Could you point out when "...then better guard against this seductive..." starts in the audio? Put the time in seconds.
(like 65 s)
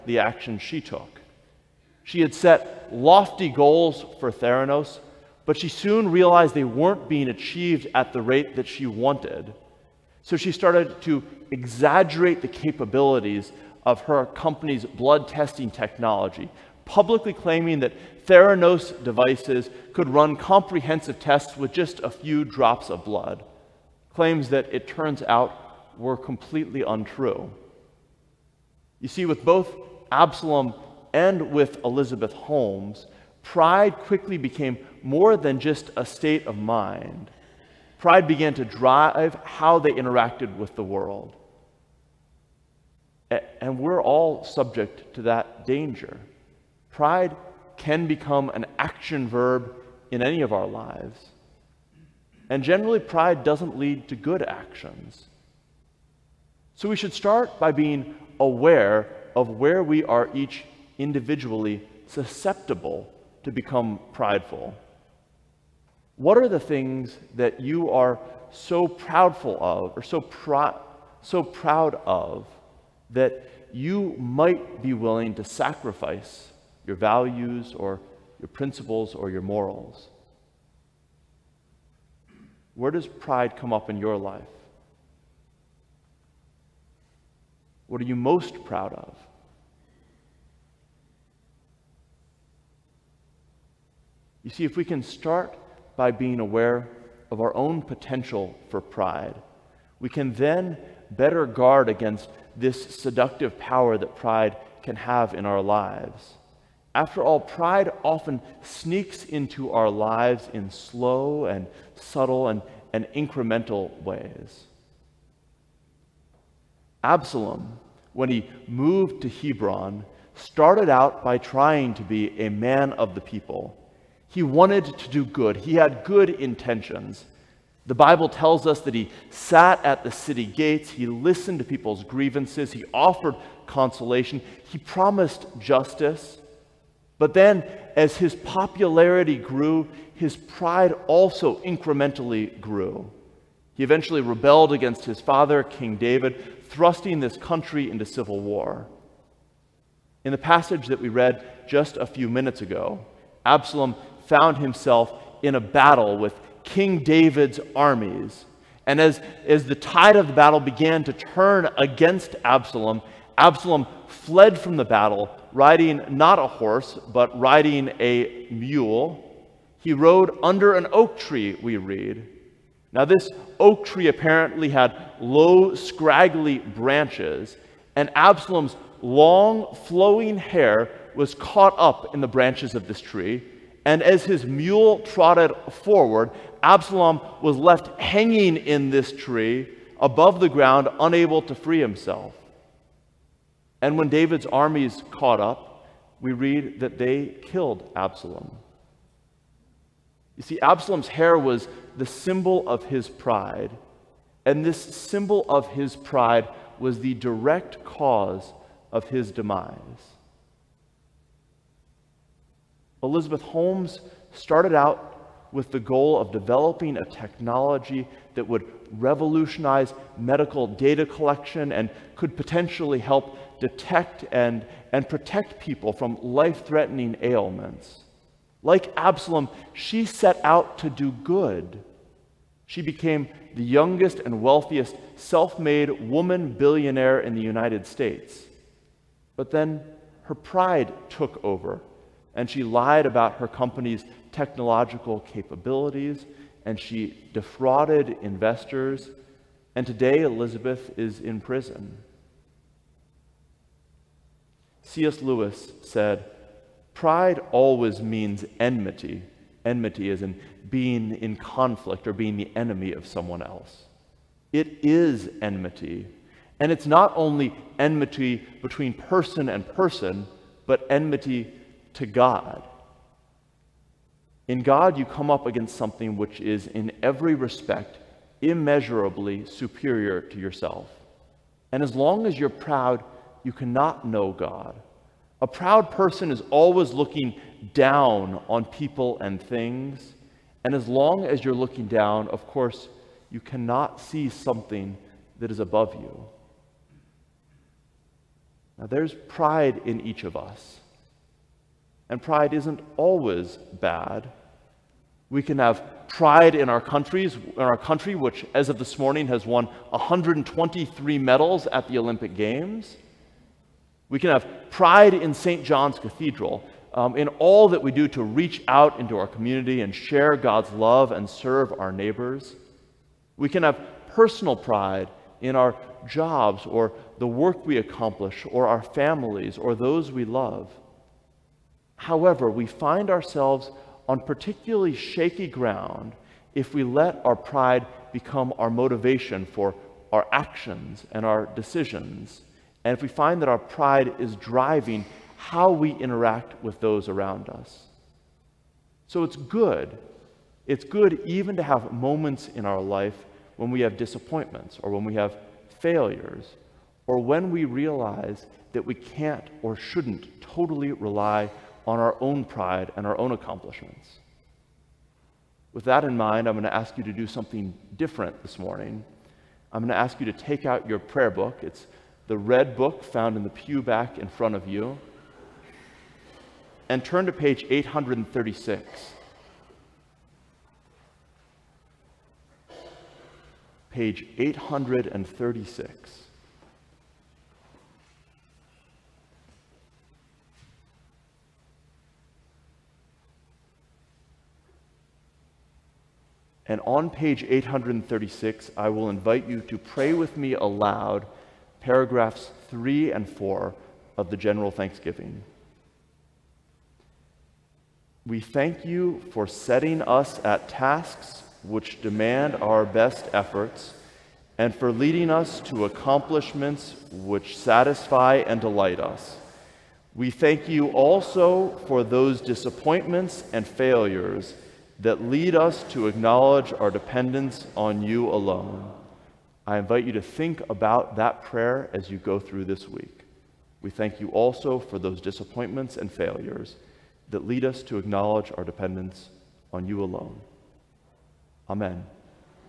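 100 s.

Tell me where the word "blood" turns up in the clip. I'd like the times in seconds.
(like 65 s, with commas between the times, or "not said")
14 s, 23 s.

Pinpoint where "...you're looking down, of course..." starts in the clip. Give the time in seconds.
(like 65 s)
291 s.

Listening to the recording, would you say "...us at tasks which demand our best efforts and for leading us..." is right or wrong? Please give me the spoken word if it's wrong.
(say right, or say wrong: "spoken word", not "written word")
right.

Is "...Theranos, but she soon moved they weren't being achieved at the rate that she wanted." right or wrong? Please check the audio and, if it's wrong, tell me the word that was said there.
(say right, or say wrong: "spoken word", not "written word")
wrong: "realized", not "moved".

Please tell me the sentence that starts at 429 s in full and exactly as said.
I invite you to think about that prayer as you go through this week.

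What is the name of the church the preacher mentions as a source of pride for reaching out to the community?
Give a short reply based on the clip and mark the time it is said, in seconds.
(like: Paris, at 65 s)
St. John's Cathedral, at 315 s.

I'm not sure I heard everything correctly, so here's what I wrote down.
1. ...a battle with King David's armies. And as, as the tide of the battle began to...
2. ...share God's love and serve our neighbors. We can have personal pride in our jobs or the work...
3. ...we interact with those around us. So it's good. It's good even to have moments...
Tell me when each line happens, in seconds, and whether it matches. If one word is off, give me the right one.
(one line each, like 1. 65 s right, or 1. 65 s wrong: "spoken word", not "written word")
1. 155 s right
2. 319 s right
3. 345 s right.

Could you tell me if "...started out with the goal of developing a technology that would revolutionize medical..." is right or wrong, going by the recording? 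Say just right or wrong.
right.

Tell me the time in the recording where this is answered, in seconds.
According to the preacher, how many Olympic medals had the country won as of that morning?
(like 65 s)
309 s.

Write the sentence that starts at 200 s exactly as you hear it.
You see, Absalom's hair was the symbol of his pride.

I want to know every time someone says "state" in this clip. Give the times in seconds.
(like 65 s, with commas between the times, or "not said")
36 s, 237 s.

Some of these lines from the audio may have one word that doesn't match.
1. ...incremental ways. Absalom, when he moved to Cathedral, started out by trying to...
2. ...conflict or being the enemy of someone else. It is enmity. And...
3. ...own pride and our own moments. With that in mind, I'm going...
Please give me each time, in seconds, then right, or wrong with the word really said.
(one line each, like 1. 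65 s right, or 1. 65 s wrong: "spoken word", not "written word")
1. 113 s wrong: "Hebron", not "Cathedral"
2. 261 s right
3. 362 s wrong: "accomplishments", not "moments".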